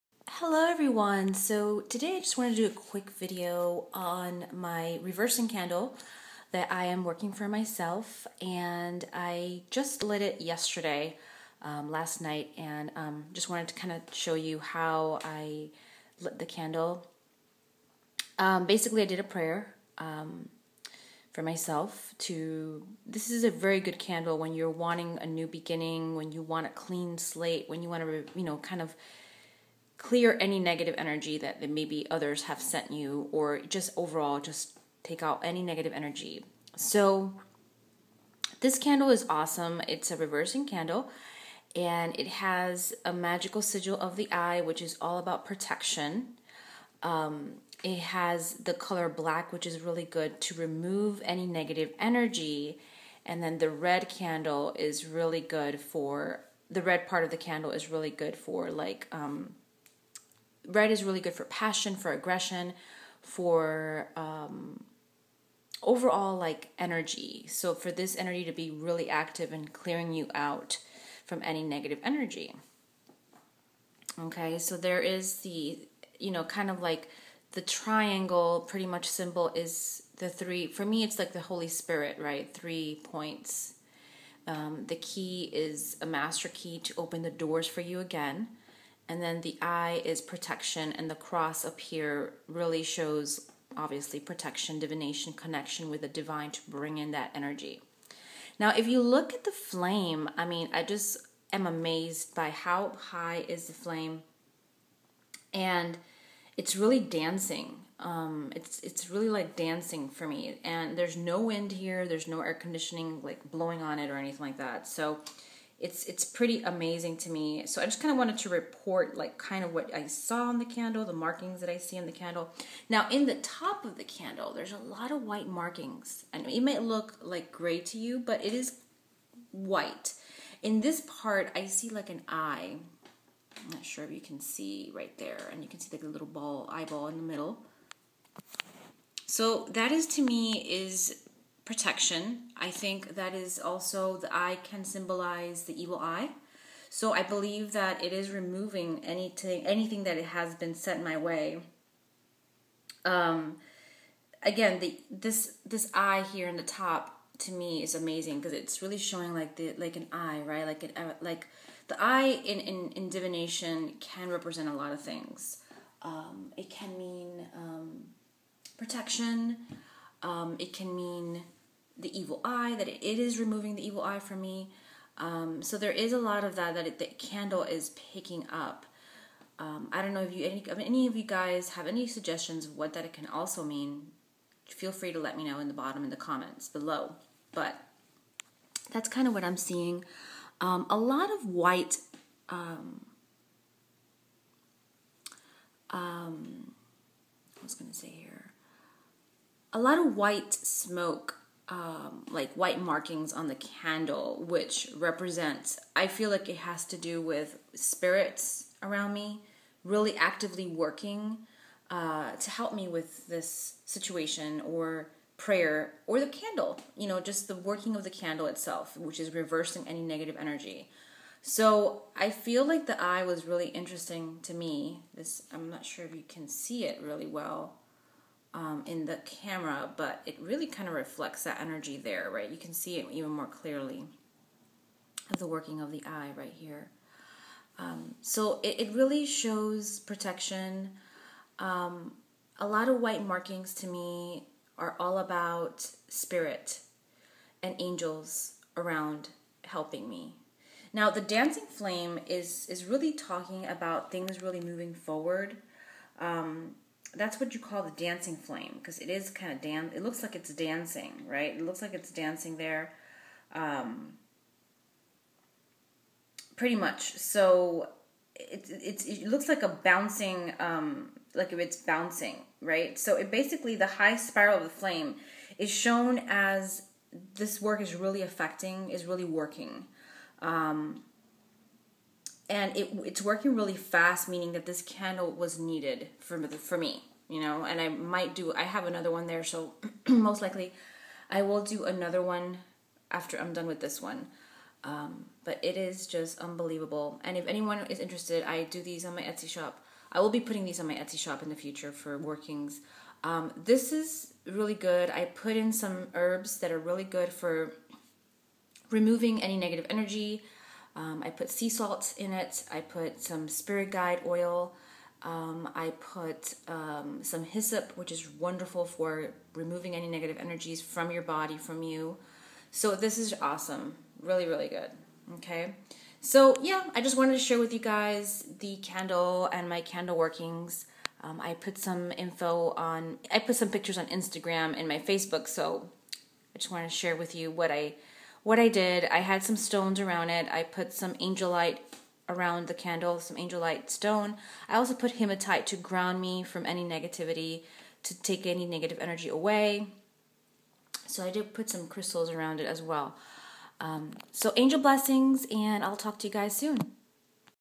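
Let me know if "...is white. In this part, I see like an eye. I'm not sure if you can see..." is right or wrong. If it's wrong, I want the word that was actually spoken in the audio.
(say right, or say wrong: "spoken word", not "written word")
right.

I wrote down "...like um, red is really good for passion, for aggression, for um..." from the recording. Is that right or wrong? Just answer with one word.
right.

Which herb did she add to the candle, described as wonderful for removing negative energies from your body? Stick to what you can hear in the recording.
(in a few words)
Hyssop.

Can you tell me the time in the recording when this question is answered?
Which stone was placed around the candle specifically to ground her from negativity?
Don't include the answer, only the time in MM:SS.
05:45.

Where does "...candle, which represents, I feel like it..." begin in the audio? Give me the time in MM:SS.
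03:23.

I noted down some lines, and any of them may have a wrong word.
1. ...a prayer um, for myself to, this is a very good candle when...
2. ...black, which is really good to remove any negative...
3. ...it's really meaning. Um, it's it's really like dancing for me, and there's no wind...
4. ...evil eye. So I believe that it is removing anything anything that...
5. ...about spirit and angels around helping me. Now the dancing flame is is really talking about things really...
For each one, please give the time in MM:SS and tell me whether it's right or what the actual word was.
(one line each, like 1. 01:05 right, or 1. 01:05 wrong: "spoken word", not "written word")
1. 00:19 right
2. 00:49 right
3. 01:46 wrong: "dancing", not "meaning"
4. 02:25 right
5. 04:05 right.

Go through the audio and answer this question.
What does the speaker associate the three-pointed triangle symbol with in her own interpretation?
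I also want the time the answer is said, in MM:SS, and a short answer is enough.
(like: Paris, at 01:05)
The Holy Spirit, at 01:21.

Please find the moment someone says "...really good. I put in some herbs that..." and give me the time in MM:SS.
05:04.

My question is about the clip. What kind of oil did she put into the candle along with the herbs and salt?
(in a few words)
Spirit guide oil.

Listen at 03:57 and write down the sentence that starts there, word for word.
Um, so it, it, really shows protection.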